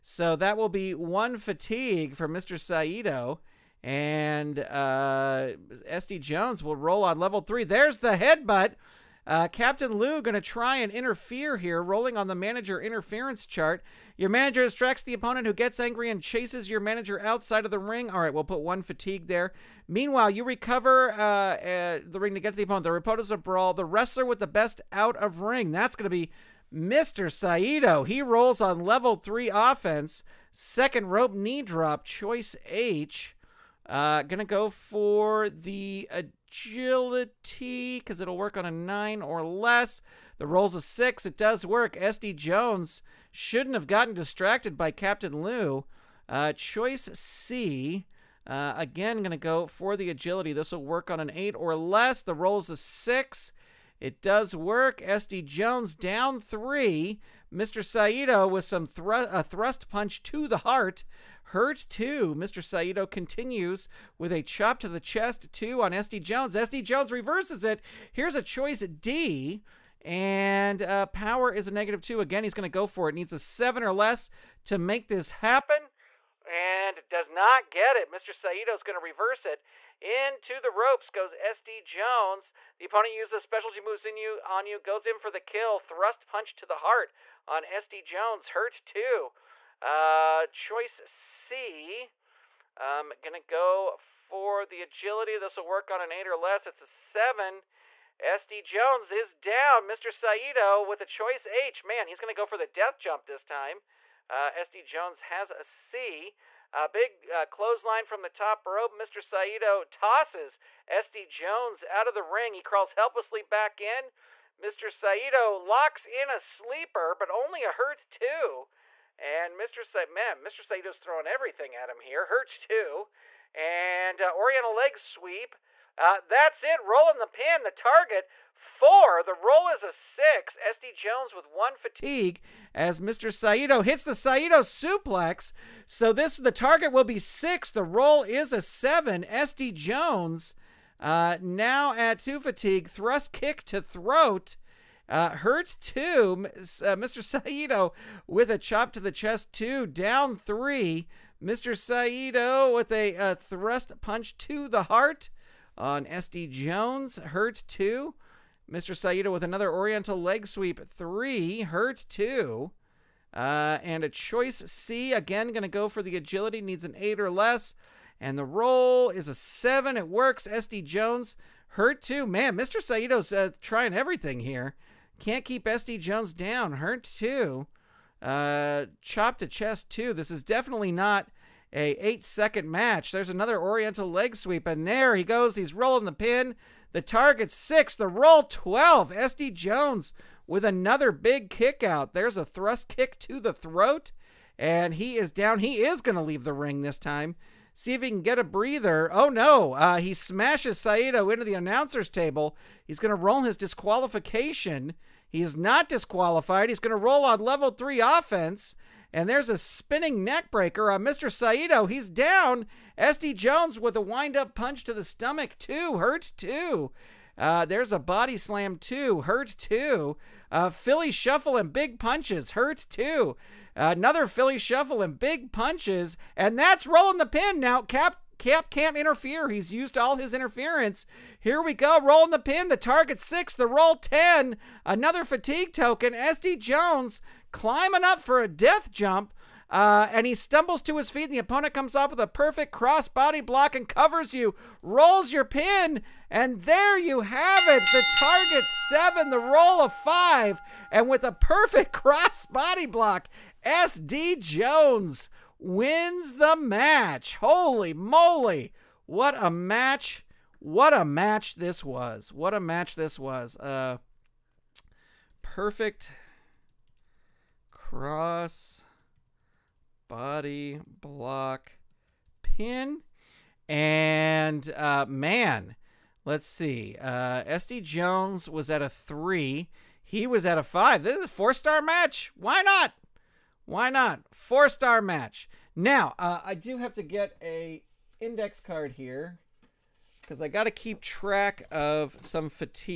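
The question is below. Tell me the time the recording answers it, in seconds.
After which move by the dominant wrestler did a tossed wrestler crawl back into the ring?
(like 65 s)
107 s.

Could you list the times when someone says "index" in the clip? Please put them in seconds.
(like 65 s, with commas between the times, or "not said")
288 s.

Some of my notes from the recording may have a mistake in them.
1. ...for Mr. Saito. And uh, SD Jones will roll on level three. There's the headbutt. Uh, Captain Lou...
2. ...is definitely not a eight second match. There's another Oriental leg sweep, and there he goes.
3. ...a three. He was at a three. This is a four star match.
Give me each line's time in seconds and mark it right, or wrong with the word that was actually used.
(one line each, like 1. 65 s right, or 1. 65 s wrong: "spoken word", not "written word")
1. 2 s right
2. 180 s right
3. 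278 s wrong: "five", not "three".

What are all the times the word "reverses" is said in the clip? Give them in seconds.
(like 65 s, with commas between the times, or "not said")
67 s, 78 s.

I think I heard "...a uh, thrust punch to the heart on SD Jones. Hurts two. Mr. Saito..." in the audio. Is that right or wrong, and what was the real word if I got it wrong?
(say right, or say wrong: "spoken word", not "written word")
right.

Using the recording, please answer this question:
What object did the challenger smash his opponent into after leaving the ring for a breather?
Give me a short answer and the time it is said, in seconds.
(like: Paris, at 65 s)
The announcer's table, at 201 s.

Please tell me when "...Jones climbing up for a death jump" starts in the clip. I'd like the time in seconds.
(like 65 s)
236 s.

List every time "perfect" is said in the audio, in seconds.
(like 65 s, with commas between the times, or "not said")
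242 s, 251 s, 265 s.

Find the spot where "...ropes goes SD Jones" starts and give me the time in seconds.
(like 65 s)
80 s.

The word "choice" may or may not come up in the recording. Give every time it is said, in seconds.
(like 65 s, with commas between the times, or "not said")
32 s, 46 s, 68 s, 90 s, 101 s, 164 s.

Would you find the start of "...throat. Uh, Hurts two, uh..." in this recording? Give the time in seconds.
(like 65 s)
143 s.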